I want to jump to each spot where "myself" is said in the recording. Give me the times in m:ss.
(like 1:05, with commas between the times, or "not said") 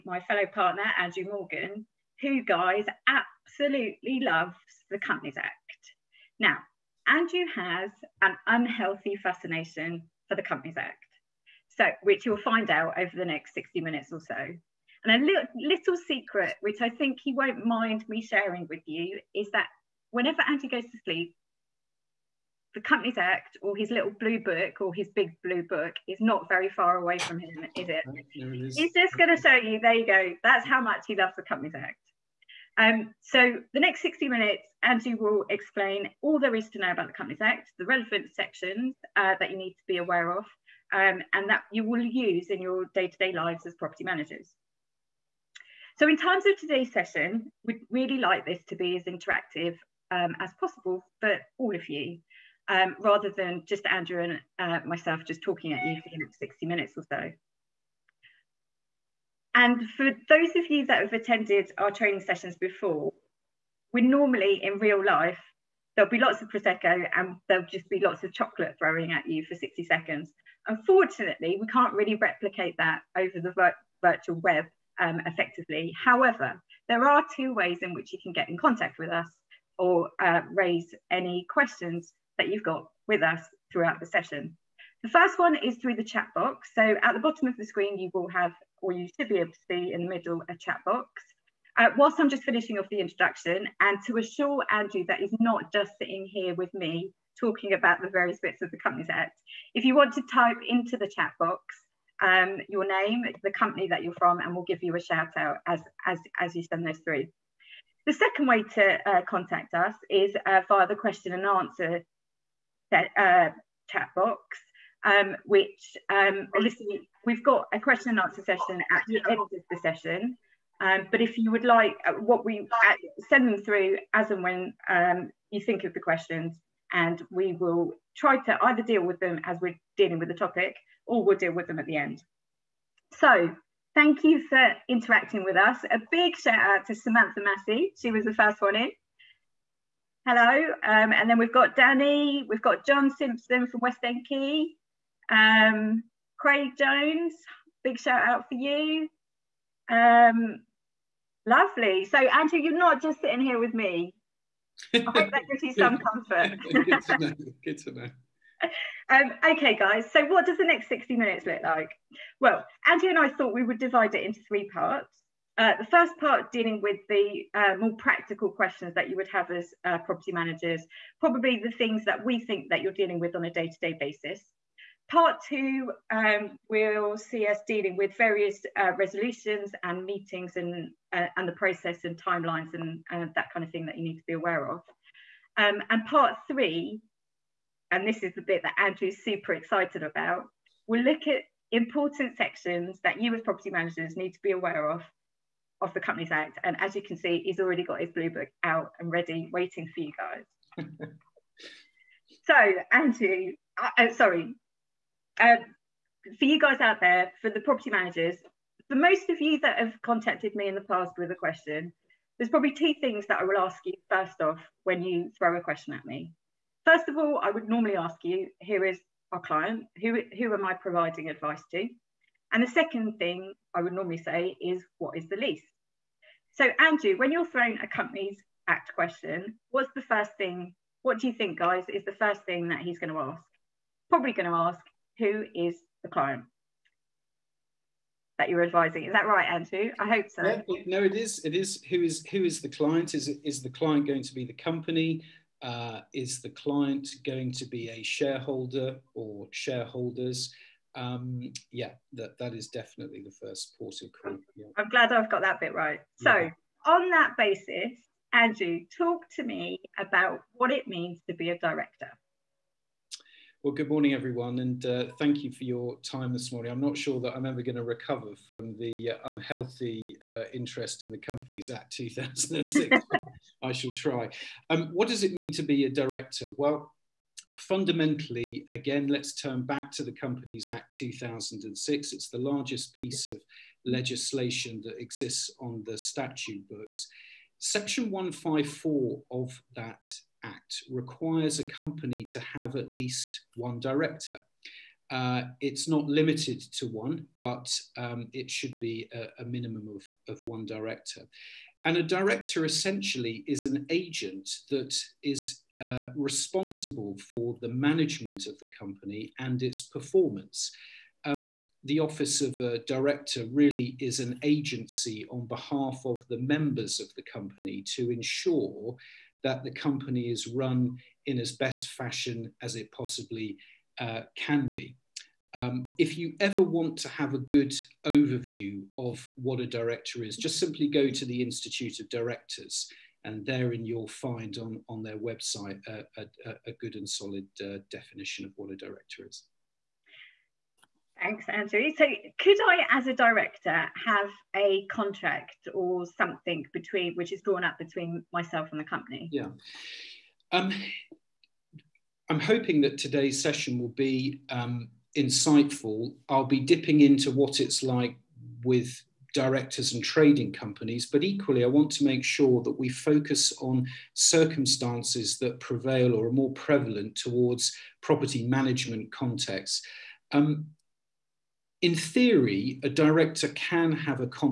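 0:54, 5:48.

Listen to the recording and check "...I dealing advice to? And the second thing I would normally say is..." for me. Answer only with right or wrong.
wrong.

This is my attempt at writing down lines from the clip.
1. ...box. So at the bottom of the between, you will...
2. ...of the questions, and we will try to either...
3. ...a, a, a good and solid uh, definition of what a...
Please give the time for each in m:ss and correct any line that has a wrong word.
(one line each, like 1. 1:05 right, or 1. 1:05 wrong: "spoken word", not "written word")
1. 1:26 wrong: "screen", not "between"
2. 2:05 right
3. 5:35 right.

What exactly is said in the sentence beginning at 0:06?
Now, Andrew has an unhealthy fascination for the Companies Act, so which you'll find out over the next 60 minutes or so.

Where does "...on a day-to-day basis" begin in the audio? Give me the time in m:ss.
2:53.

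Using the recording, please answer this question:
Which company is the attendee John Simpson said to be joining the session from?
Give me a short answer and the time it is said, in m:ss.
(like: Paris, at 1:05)
West End Key, at 2:23.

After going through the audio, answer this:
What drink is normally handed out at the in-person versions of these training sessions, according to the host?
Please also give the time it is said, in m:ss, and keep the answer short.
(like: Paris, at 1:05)
Prosecco, at 1:06.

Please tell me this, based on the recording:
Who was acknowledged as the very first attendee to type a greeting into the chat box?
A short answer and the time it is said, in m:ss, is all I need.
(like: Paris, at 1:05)
Samantha Massey, at 2:16.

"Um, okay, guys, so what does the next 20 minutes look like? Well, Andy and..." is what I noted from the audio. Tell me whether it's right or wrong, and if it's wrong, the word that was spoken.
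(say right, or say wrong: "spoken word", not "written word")
wrong: "60", not "20".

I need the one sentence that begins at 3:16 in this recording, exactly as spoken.
And as you can see, he's already got his blue book out and ready, waiting for you guys.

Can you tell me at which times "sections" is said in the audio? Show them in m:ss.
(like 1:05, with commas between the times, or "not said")
0:38, 3:12, 4:47.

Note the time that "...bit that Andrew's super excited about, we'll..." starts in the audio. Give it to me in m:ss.
3:08.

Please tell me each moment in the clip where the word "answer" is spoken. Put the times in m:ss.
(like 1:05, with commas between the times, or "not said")
1:51, 1:58.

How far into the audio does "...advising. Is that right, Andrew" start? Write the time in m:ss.
3:58.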